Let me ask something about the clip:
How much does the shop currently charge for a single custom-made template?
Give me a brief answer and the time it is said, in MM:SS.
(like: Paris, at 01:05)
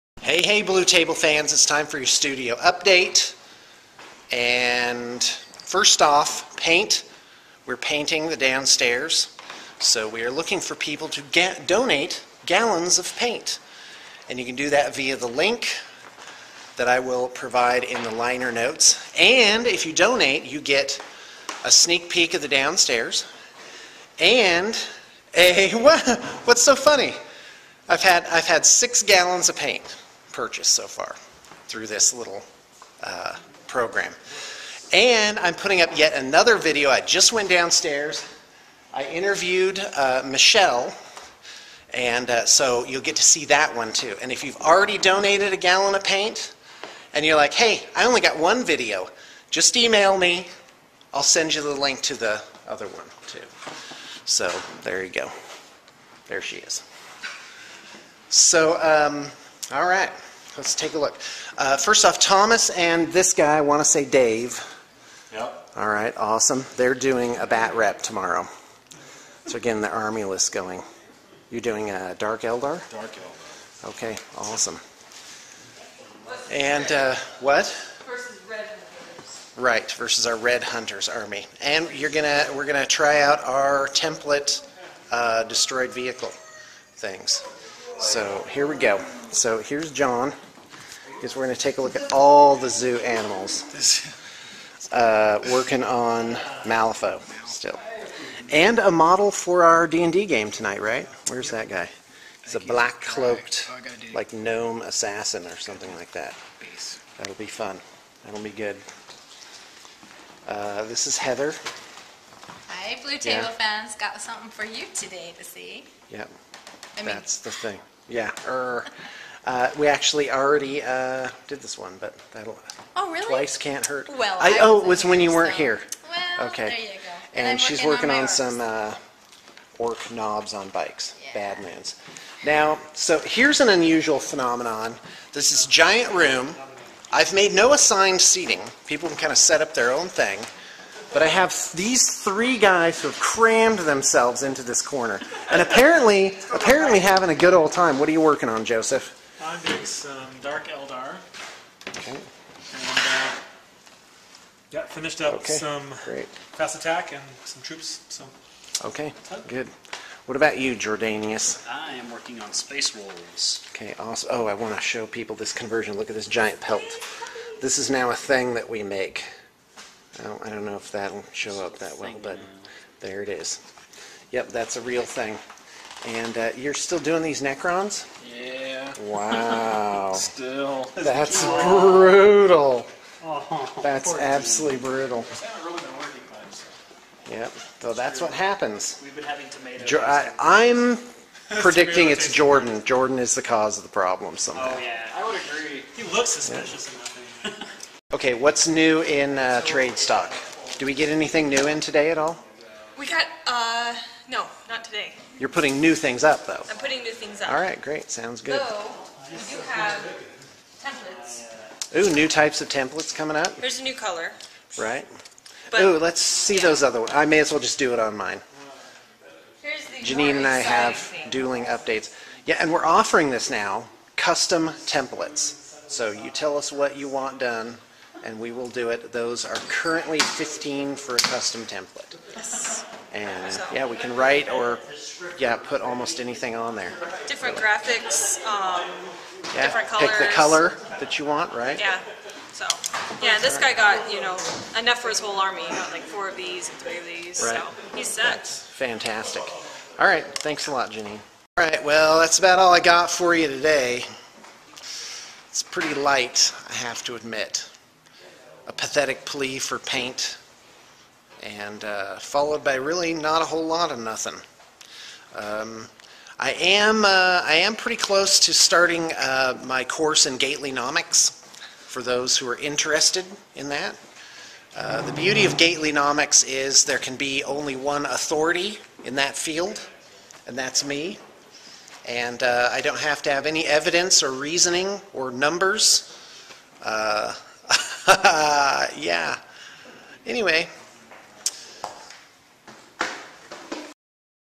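15, at 03:50.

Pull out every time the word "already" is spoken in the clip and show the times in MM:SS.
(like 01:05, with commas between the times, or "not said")
00:44, 02:00.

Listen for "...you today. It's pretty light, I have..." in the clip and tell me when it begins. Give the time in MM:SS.
04:13.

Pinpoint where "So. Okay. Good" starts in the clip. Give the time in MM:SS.
02:38.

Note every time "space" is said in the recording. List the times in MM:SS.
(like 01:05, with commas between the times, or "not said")
02:42.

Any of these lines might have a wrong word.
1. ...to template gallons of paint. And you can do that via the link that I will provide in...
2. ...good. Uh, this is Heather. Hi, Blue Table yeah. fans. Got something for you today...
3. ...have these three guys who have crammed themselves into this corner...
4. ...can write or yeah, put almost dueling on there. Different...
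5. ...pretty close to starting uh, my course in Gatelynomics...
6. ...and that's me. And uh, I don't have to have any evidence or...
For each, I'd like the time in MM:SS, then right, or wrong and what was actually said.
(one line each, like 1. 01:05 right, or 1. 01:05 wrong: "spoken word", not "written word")
1. 00:11 wrong: "donate", not "template"
2. 01:48 right
3. 02:21 right
4. 03:53 wrong: "anything", not "dueling"
5. 04:27 right
6. 04:40 right.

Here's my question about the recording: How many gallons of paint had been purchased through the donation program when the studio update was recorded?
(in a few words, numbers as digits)
6.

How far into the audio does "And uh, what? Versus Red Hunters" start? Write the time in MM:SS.
01:16.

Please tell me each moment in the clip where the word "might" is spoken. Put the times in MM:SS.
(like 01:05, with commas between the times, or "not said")
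not said.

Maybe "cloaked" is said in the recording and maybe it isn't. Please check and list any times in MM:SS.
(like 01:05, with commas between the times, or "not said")
01:42.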